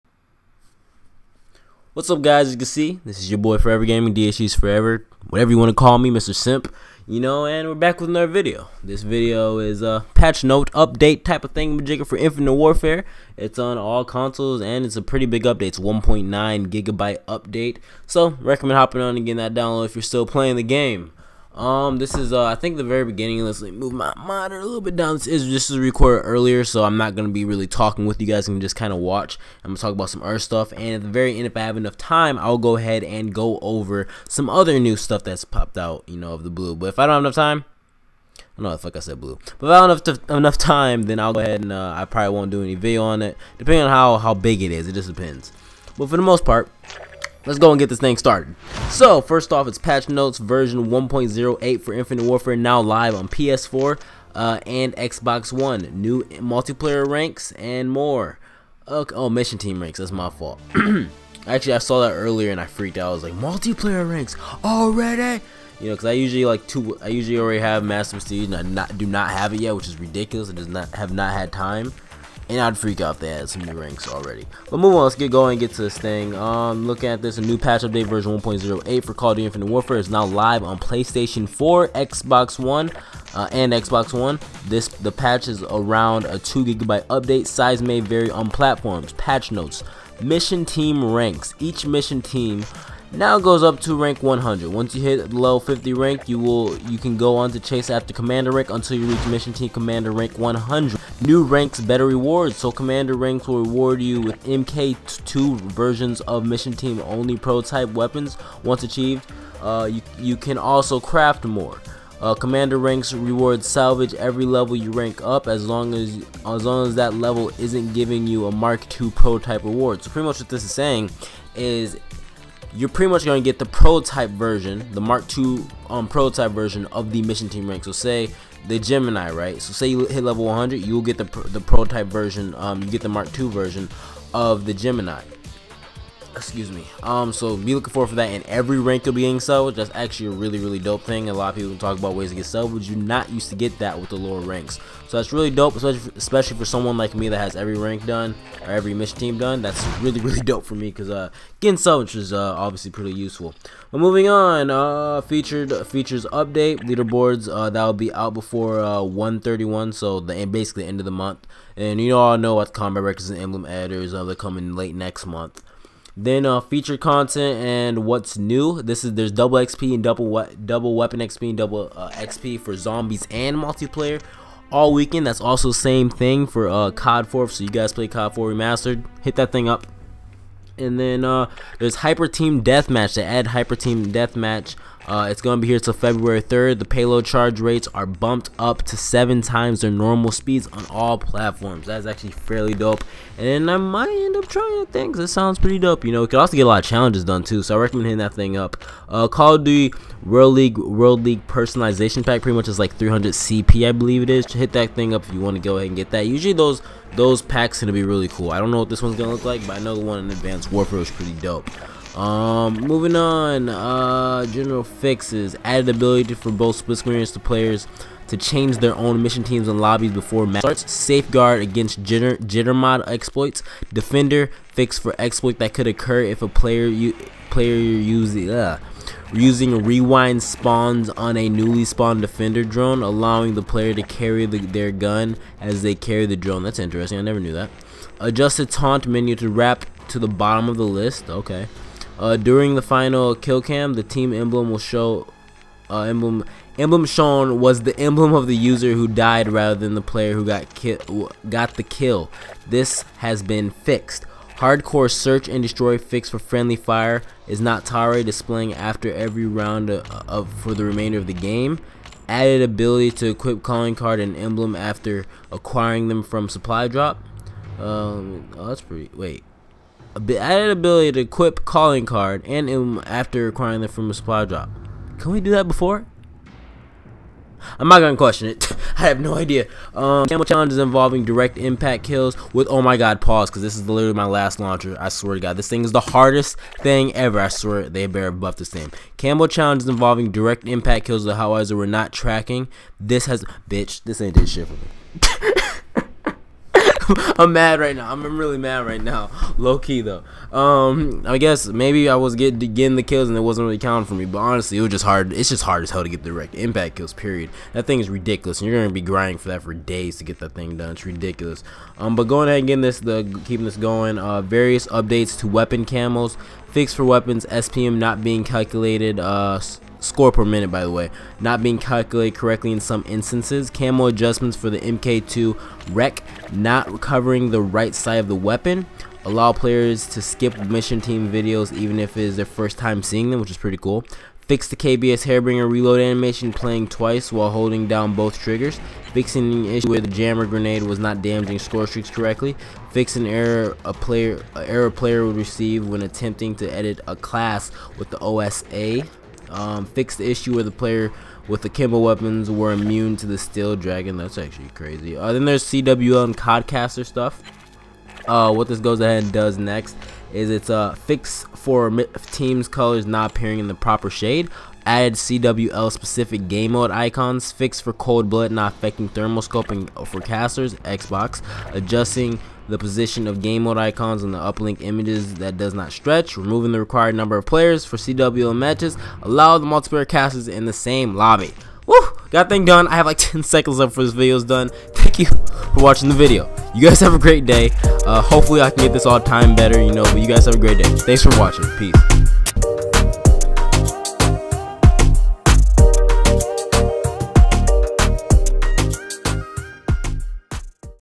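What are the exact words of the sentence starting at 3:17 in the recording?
So I recommend hitting that thing up.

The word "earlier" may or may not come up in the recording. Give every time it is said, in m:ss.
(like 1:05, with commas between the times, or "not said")
0:26, 1:02.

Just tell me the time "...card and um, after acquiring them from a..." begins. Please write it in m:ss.
4:32.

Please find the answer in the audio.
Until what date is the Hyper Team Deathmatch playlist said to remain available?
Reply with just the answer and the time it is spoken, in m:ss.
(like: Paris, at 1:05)
February 3rd, at 3:05.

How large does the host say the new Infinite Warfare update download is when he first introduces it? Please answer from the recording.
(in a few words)
1.9 gigabytes.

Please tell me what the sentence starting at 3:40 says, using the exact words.
Safeguard against jitter, jitter mod exploits.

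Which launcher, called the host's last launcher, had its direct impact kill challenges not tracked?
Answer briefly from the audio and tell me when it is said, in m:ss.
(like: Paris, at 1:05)
Howitzer, at 4:51.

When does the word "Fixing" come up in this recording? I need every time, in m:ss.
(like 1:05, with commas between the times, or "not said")
5:39.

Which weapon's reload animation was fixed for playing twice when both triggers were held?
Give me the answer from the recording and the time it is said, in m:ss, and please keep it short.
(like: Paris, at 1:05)
KBS Harbinger, at 5:34.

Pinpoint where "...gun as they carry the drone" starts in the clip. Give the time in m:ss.
3:54.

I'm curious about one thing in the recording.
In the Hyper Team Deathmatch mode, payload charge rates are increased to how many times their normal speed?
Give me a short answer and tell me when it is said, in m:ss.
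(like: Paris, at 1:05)
7, at 3:08.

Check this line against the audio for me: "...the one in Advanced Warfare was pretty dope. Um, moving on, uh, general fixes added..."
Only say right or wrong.
right.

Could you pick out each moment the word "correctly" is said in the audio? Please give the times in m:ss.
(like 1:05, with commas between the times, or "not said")
5:22, 5:42.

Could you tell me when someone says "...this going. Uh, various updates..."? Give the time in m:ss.
5:13.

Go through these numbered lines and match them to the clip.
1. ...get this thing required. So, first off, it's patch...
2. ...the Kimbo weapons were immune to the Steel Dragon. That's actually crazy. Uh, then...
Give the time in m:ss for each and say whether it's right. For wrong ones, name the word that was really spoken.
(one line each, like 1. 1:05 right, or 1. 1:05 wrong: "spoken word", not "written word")
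1. 0:47 wrong: "started", not "required"
2. 5:51 right.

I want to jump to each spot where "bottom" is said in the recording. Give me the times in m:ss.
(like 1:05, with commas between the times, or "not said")
4:00.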